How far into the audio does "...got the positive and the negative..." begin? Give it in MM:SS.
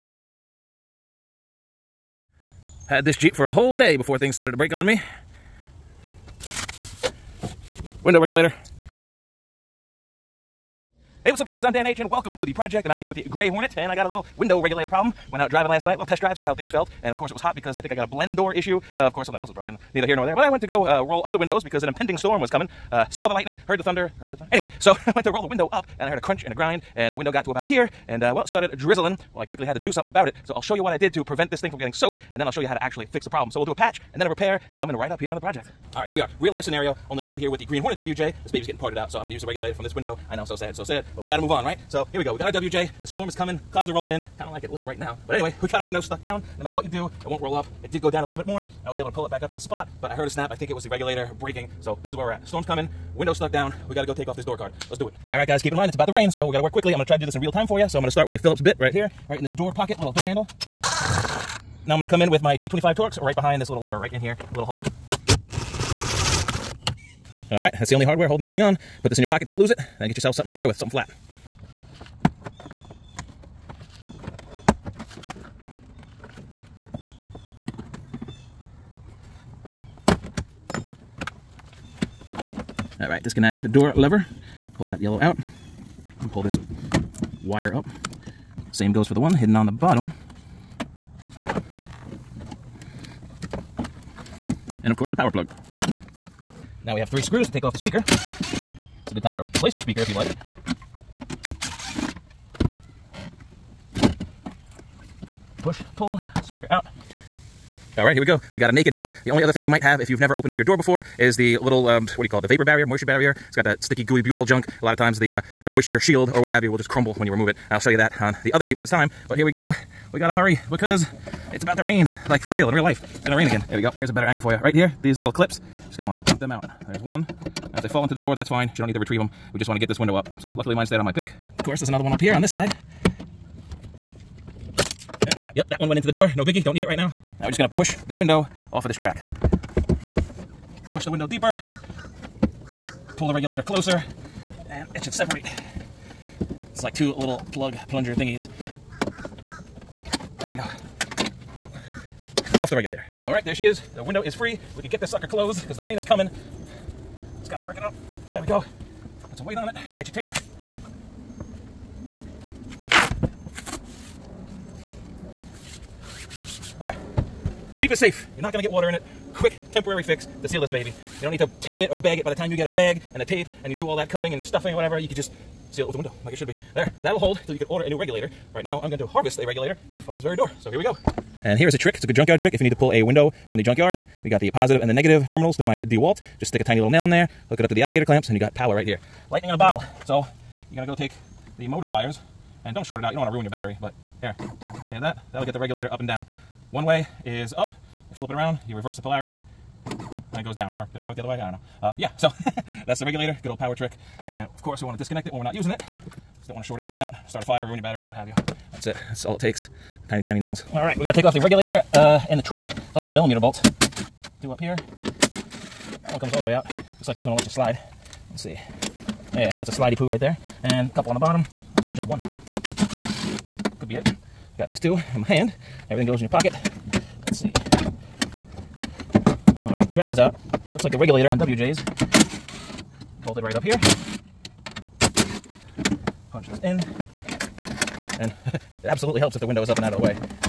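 03:04.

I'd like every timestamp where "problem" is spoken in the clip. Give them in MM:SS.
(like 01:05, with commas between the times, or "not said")
00:14, 00:33.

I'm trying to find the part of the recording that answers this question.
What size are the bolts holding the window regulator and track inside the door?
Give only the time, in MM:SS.
03:33.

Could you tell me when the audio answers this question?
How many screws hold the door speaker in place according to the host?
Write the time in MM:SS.
01:37.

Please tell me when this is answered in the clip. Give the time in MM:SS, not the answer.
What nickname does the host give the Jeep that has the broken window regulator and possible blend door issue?
00:13.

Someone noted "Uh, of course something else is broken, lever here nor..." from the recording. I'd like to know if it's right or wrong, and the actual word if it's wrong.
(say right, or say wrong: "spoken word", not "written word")
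wrong: "neither", not "lever".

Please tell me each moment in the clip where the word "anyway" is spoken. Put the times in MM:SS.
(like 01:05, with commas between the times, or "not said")
00:24, 00:45.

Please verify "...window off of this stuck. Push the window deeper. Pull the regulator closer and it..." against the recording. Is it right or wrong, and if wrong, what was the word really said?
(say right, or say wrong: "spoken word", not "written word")
wrong: "track", not "stuck".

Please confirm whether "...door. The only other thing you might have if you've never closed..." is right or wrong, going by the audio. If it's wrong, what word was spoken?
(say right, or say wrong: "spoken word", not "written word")
wrong: "opened", not "closed".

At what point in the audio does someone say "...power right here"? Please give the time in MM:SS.
03:08.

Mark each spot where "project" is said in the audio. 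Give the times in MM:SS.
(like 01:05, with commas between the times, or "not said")
00:12, 00:35.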